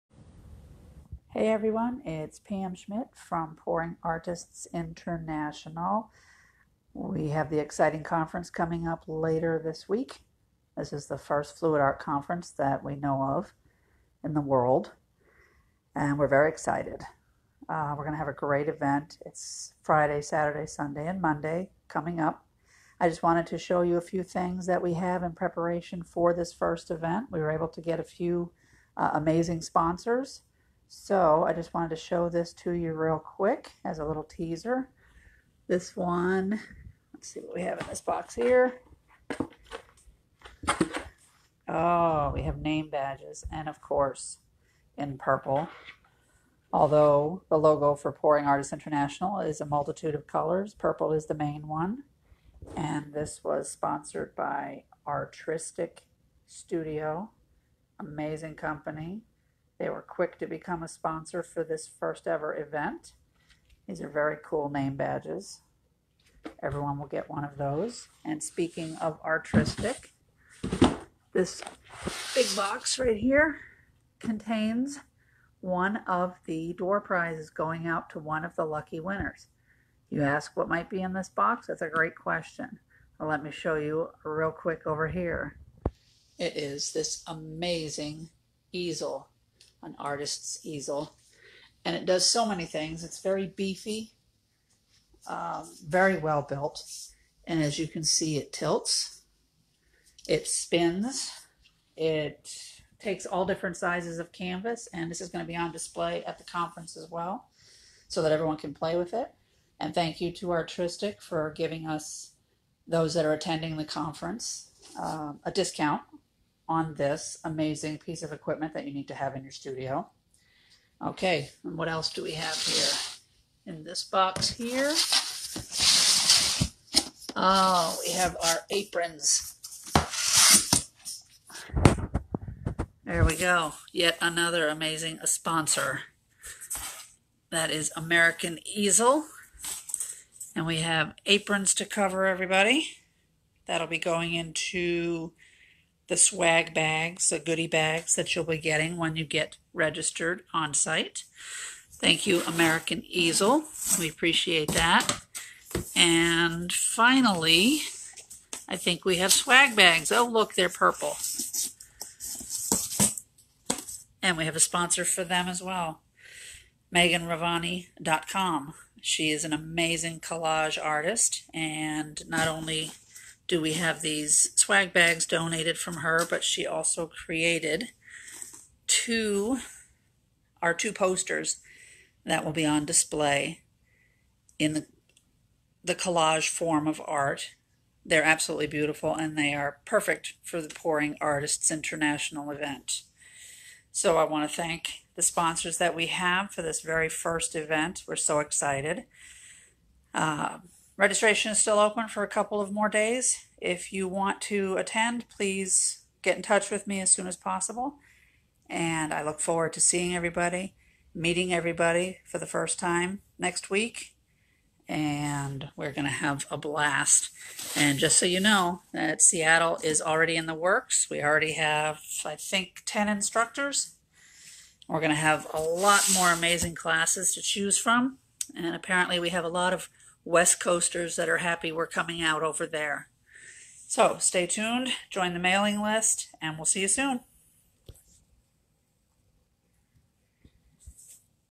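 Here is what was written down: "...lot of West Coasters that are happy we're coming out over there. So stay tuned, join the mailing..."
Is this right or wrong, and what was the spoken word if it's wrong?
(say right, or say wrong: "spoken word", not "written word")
right.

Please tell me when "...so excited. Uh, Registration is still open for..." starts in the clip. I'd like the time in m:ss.
3:18.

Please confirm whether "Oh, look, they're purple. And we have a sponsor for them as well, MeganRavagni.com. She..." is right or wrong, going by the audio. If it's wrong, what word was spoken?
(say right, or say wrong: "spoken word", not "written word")
right.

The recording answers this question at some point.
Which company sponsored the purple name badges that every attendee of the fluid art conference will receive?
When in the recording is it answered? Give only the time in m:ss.
0:55.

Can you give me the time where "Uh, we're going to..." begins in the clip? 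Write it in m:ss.
0:17.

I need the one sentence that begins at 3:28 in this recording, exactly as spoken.
And I look forward to seeing everybody, meeting everybody for the first time next week.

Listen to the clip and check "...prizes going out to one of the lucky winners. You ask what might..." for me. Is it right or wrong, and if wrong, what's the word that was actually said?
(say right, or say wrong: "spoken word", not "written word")
right.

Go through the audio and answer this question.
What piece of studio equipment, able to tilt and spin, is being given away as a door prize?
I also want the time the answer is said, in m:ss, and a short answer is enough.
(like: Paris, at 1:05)
An artist's easel, at 1:29.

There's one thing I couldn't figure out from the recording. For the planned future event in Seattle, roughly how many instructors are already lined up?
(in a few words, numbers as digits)
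10.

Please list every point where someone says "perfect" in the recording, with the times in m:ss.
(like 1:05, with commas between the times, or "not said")
3:09.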